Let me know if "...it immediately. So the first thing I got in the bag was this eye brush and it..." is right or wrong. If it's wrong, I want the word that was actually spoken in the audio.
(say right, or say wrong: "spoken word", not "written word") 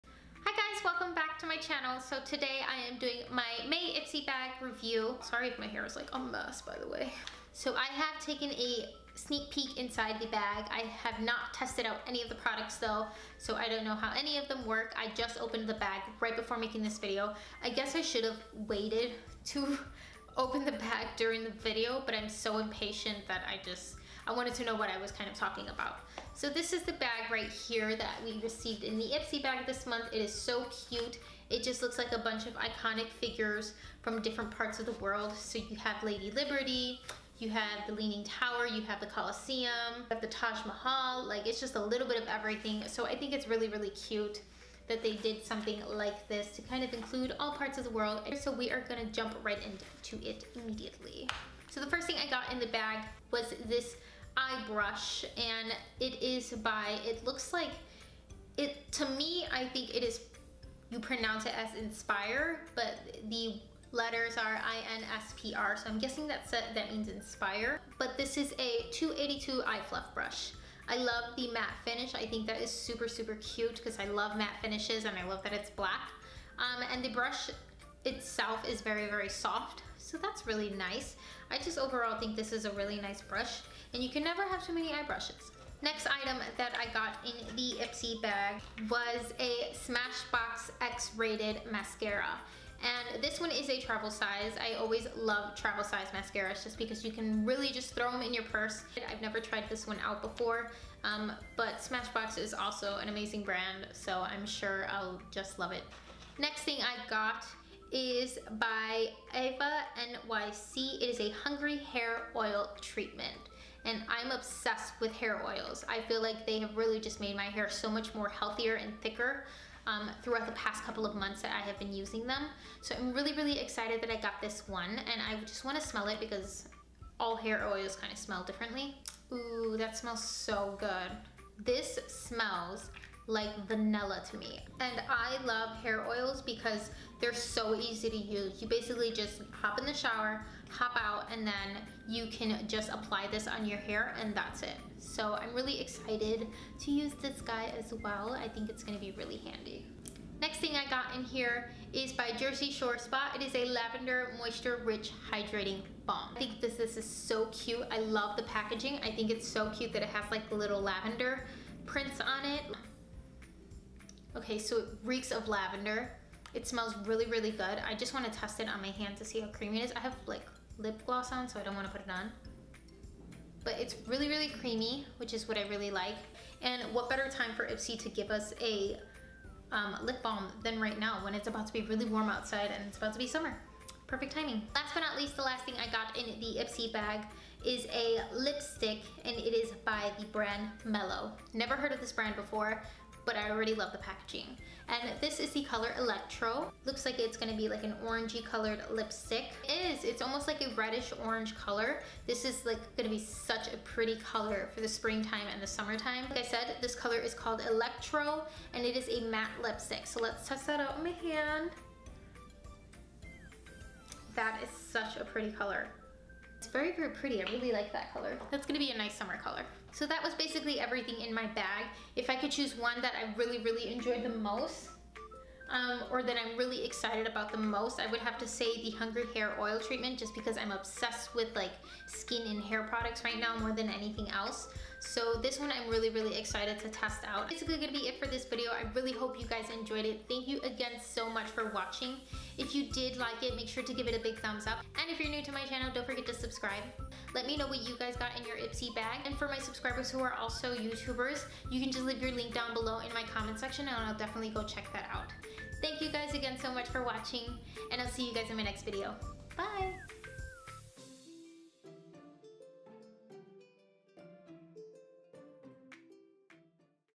right.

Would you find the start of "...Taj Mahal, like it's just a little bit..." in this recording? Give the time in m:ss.
0:40.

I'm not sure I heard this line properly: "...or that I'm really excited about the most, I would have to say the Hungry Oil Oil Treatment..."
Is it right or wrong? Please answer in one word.
wrong.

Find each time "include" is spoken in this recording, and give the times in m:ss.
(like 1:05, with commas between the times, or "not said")
0:46.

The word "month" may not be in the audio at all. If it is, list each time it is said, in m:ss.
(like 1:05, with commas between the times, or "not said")
0:29, 2:01.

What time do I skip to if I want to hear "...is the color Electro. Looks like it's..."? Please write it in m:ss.
3:15.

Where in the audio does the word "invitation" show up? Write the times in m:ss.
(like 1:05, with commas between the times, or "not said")
not said.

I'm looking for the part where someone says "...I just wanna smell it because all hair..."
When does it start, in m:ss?
2:05.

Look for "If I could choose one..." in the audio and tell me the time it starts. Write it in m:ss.
3:42.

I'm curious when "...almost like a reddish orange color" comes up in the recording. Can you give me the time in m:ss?
3:20.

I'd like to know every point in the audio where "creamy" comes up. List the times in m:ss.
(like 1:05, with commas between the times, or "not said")
2:49, 2:54.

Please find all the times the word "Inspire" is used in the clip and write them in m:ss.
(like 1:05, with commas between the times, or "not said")
1:01, 1:07.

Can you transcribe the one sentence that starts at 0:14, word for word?
I just opened the bag right before making this video.